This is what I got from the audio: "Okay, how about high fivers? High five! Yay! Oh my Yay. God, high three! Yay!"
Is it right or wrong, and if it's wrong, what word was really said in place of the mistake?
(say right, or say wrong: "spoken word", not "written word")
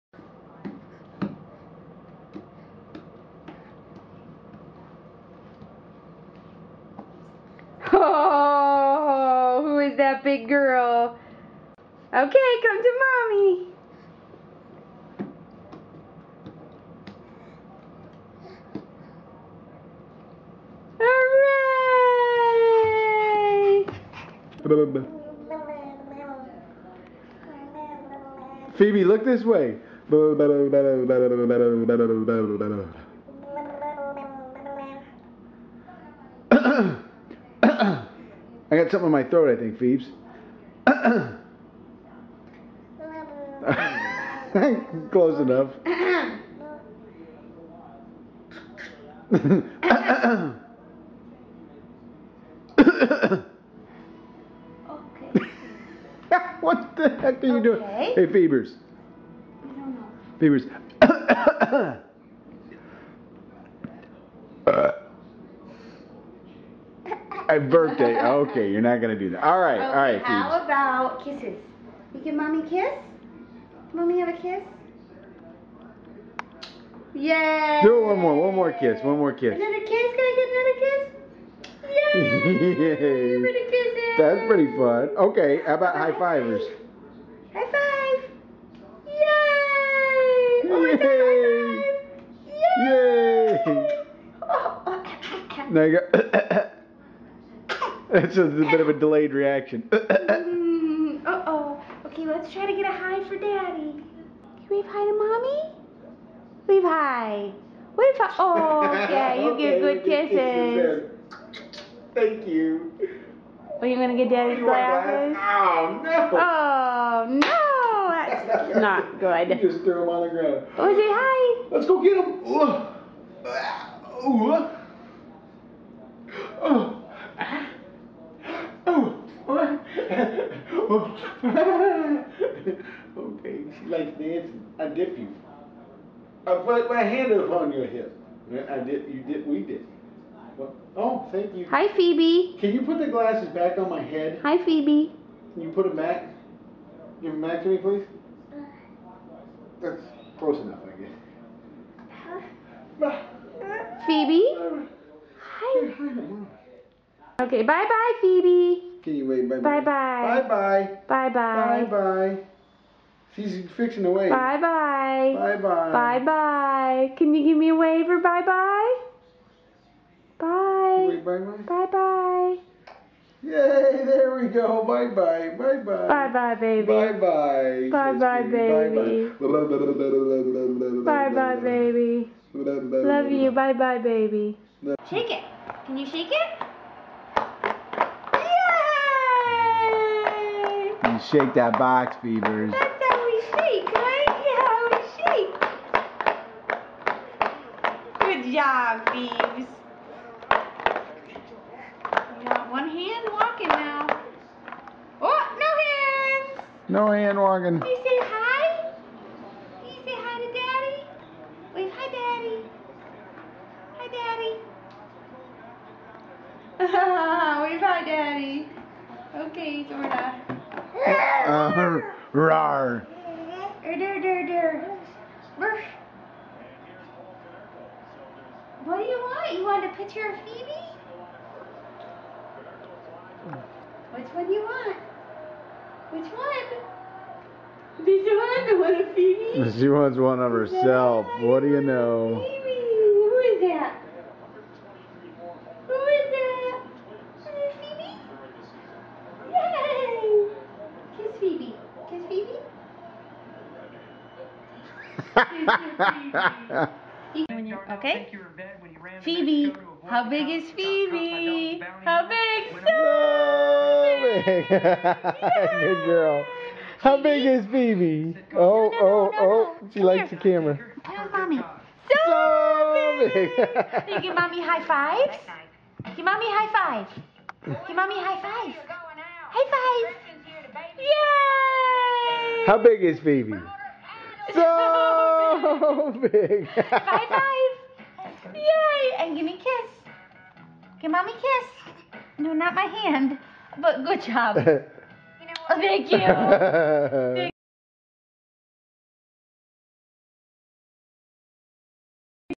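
wrong: "five", not "three".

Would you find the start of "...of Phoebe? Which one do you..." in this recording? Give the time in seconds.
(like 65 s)
230 s.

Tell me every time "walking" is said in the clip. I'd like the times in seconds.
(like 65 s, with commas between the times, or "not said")
203 s, 207 s.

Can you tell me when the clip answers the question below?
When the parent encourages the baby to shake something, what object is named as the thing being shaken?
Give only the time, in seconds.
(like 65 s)
191 s.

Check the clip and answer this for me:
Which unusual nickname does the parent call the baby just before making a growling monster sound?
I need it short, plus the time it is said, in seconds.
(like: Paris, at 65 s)
Zorda, at 219 s.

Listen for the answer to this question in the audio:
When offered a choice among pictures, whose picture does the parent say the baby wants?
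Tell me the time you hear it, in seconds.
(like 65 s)
240 s.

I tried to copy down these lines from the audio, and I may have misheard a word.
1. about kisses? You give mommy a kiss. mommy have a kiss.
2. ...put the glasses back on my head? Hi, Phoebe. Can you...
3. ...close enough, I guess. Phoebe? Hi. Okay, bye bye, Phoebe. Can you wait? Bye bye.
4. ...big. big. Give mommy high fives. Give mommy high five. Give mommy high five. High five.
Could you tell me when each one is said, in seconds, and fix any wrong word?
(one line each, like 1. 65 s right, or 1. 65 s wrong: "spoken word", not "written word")
1. 70 s right
2. 142 s right
3. 150 s right
4. 273 s right.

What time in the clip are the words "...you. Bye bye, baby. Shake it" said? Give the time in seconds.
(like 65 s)
183 s.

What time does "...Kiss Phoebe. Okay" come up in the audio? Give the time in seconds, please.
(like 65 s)
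256 s.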